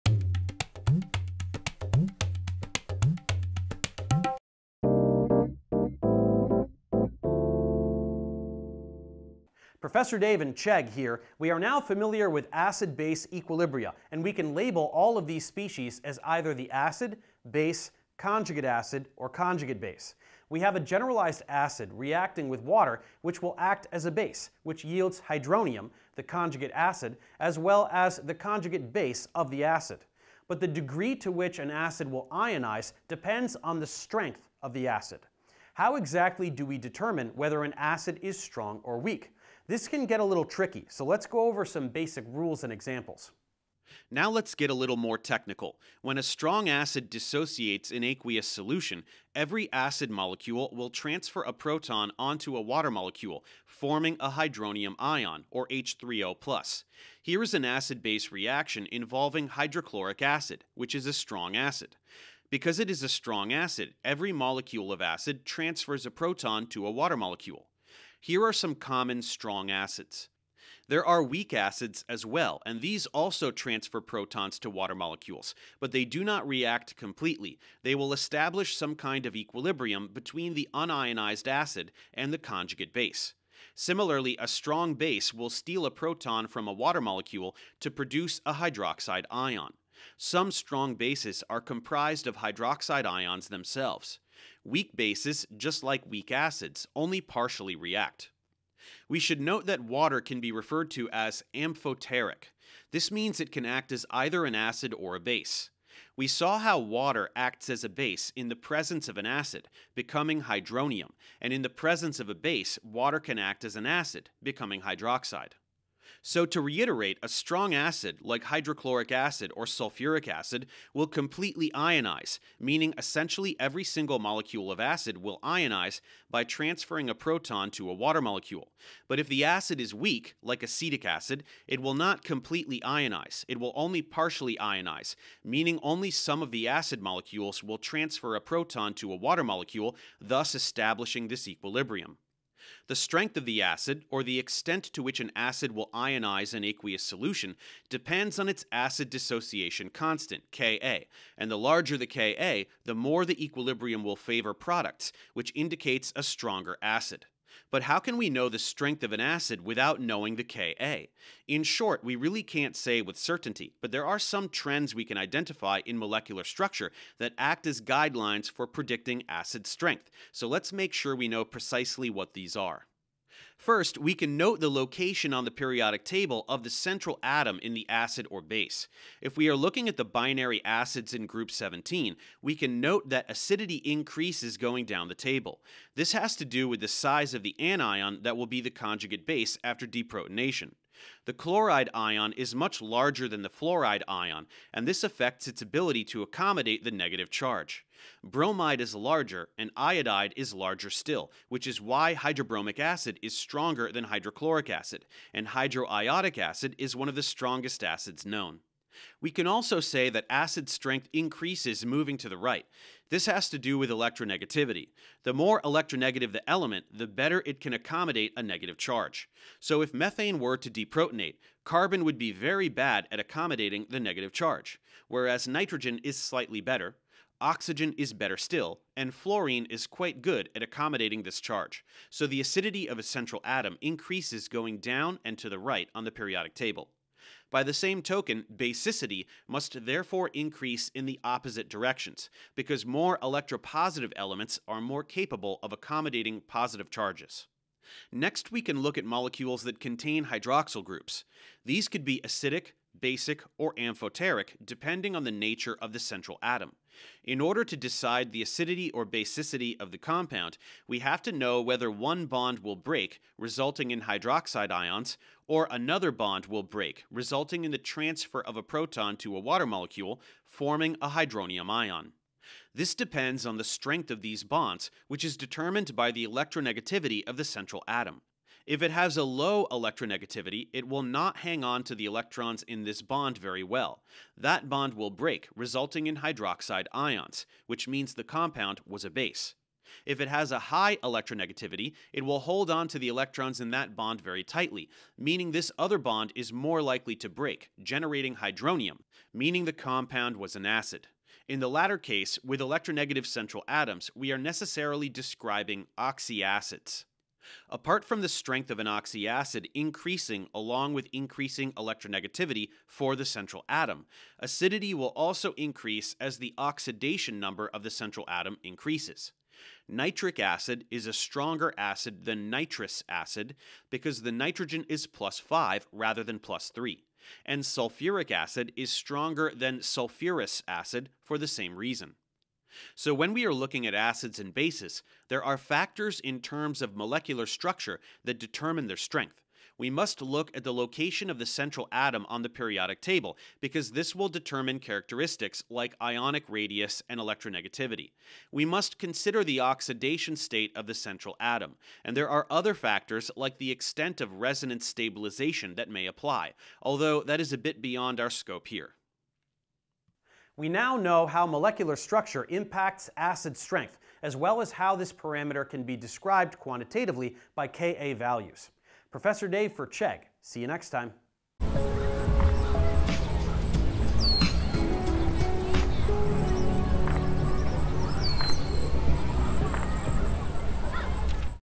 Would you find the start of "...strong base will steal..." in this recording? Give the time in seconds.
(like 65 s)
84 s.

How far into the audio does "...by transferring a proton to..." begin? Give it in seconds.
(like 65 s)
126 s.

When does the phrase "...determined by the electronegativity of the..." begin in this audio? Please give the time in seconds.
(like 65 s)
275 s.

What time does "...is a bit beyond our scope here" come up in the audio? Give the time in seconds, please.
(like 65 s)
357 s.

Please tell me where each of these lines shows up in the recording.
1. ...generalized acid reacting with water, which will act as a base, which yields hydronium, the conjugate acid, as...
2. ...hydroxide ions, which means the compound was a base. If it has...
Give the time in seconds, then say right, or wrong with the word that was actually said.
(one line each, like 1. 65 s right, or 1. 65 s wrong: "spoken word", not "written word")
1. 20 s right
2. 286 s right.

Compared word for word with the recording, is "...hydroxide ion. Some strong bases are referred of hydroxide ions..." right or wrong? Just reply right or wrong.
wrong.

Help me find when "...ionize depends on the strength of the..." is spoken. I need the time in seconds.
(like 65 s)
32 s.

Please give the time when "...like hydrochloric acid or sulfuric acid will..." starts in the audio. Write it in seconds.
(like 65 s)
118 s.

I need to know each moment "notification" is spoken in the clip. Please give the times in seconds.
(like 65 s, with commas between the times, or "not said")
not said.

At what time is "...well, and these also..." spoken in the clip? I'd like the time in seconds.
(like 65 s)
72 s.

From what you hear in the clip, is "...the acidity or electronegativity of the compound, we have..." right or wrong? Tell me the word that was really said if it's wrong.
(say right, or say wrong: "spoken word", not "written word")
wrong: "basicity", not "electronegativity".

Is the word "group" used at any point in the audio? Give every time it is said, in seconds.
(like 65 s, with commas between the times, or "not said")
181 s, 250 s.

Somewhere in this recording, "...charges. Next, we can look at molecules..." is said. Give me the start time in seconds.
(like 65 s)
246 s.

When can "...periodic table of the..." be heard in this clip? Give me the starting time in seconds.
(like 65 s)
175 s.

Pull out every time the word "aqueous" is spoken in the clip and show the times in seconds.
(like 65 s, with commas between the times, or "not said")
48 s, 146 s.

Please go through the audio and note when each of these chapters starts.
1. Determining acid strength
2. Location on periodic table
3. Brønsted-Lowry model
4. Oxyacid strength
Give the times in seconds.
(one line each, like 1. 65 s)
1. 124 s
2. 177 s
3. 52 s
4. 250 s.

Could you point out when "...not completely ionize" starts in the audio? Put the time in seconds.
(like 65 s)
131 s.